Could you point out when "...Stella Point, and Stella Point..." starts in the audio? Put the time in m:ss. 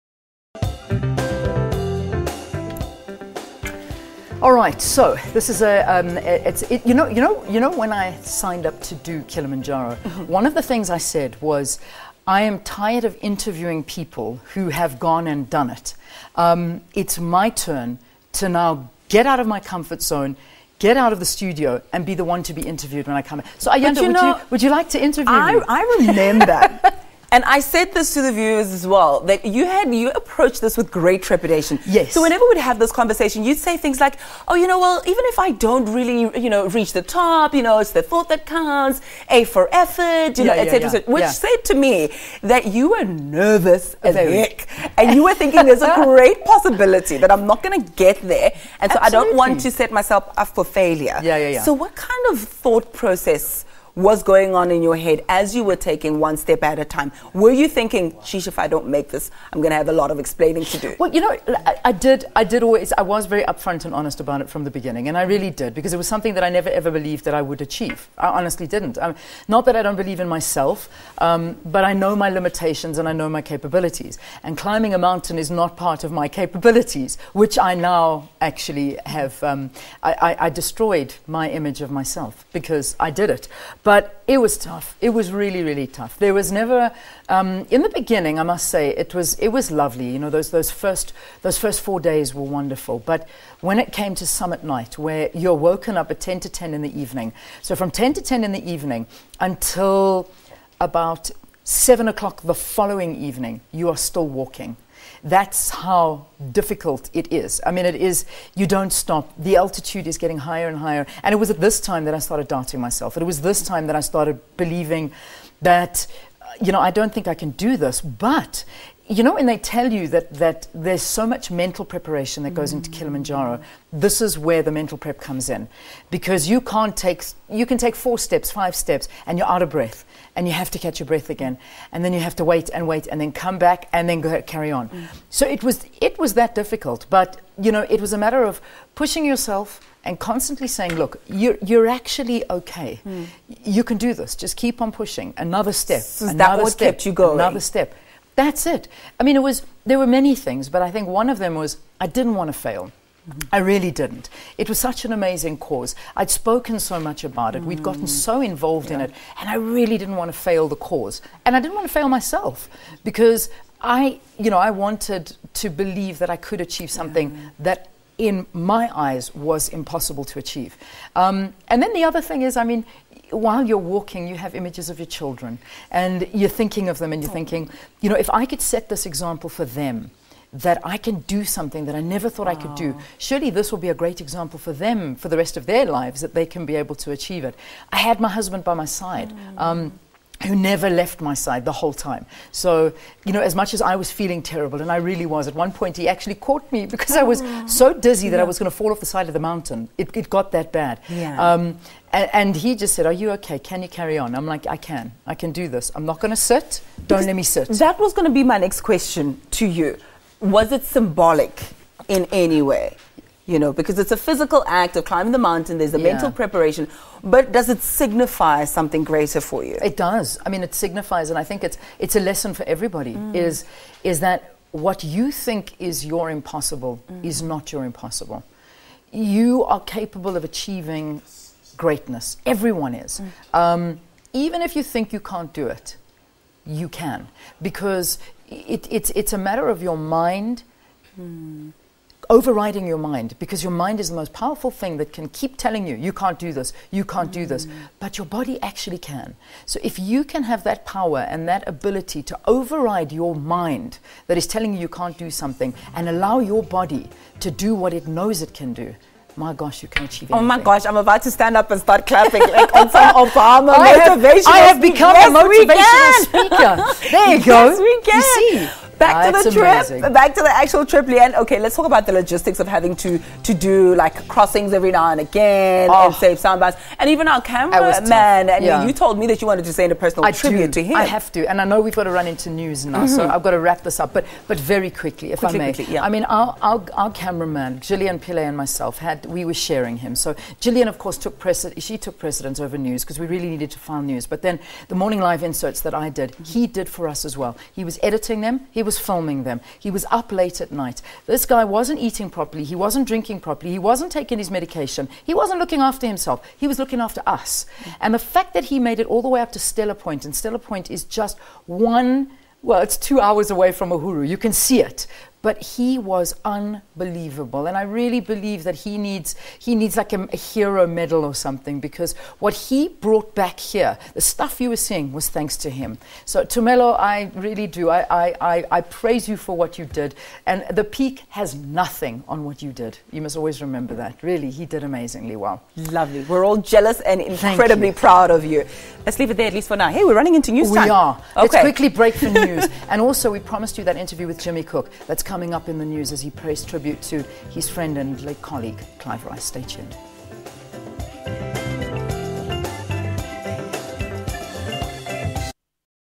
5:09.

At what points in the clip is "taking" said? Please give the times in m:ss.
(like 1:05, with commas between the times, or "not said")
0:55, 5:04.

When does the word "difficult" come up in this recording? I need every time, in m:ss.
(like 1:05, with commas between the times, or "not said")
1:46, 2:16.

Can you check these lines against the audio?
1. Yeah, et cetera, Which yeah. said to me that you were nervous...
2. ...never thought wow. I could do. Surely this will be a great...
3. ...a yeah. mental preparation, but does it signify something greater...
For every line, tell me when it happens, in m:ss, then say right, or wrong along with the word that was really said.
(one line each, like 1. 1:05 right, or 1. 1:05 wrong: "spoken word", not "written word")
1. 0:40 right
2. 3:02 right
3. 3:35 right.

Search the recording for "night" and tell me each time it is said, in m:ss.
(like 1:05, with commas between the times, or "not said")
1:34, 5:00.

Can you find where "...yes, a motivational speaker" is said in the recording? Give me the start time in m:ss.
4:25.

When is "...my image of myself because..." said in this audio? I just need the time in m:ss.
1:21.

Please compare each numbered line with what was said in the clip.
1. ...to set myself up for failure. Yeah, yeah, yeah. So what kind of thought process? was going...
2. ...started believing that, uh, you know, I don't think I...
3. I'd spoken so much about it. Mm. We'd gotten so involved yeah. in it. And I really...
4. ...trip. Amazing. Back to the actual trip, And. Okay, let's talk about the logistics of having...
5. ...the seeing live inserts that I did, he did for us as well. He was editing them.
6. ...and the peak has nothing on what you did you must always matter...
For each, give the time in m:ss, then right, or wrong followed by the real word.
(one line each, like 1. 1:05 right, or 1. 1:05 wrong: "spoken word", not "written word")
1. 0:49 right
2. 1:54 right
3. 2:36 right
4. 4:29 wrong: "Leanne", not "And"
5. 4:54 wrong: "morning", not "seeing"
6. 5:30 wrong: "remember", not "matter".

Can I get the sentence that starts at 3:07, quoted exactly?
I had my husband by my side.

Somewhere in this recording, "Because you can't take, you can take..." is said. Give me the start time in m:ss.
2:06.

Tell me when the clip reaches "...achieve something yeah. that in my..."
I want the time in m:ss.
2:46.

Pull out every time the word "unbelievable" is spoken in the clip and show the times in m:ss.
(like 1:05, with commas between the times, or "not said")
5:16.